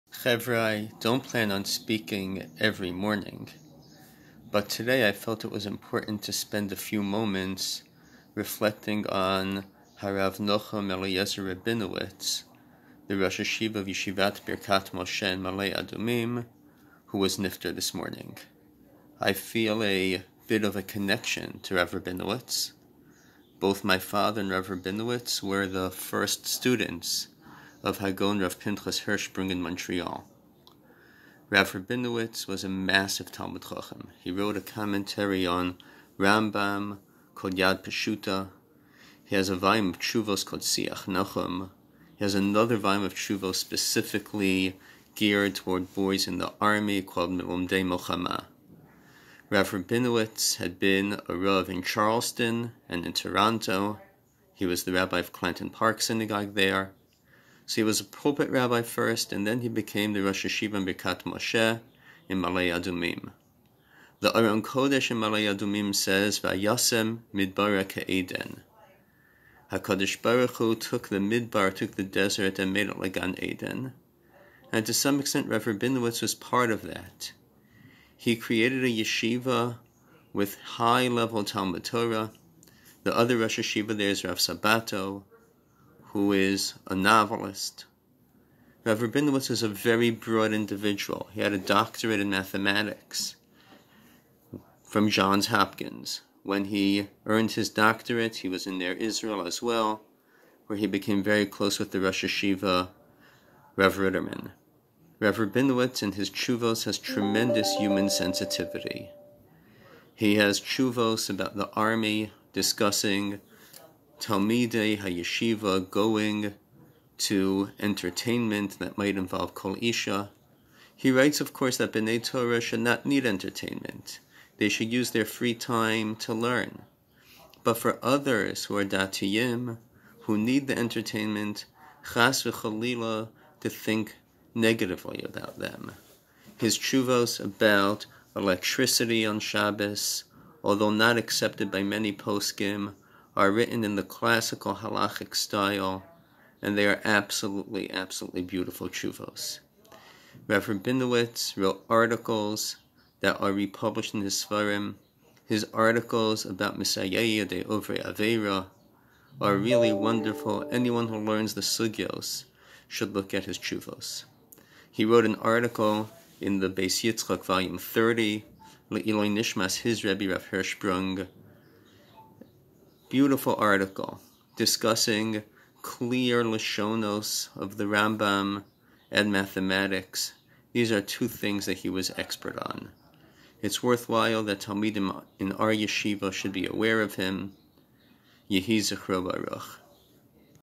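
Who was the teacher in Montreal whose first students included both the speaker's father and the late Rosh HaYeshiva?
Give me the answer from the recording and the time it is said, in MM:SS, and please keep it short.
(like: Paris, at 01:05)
Rav Pinchas Hirschsprung, at 00:28.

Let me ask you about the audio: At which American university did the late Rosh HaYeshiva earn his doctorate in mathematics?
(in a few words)
Johns Hopkins.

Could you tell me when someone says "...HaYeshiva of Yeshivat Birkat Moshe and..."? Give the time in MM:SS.
00:13.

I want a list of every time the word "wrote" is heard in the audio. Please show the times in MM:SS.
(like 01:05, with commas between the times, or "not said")
00:34, 02:31, 02:45.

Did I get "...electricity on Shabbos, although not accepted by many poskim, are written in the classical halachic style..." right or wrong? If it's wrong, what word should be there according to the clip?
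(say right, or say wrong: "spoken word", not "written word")
right.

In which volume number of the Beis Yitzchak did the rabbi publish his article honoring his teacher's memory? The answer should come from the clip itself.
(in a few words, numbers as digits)
30.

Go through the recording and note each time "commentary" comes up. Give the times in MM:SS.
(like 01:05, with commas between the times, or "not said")
00:34.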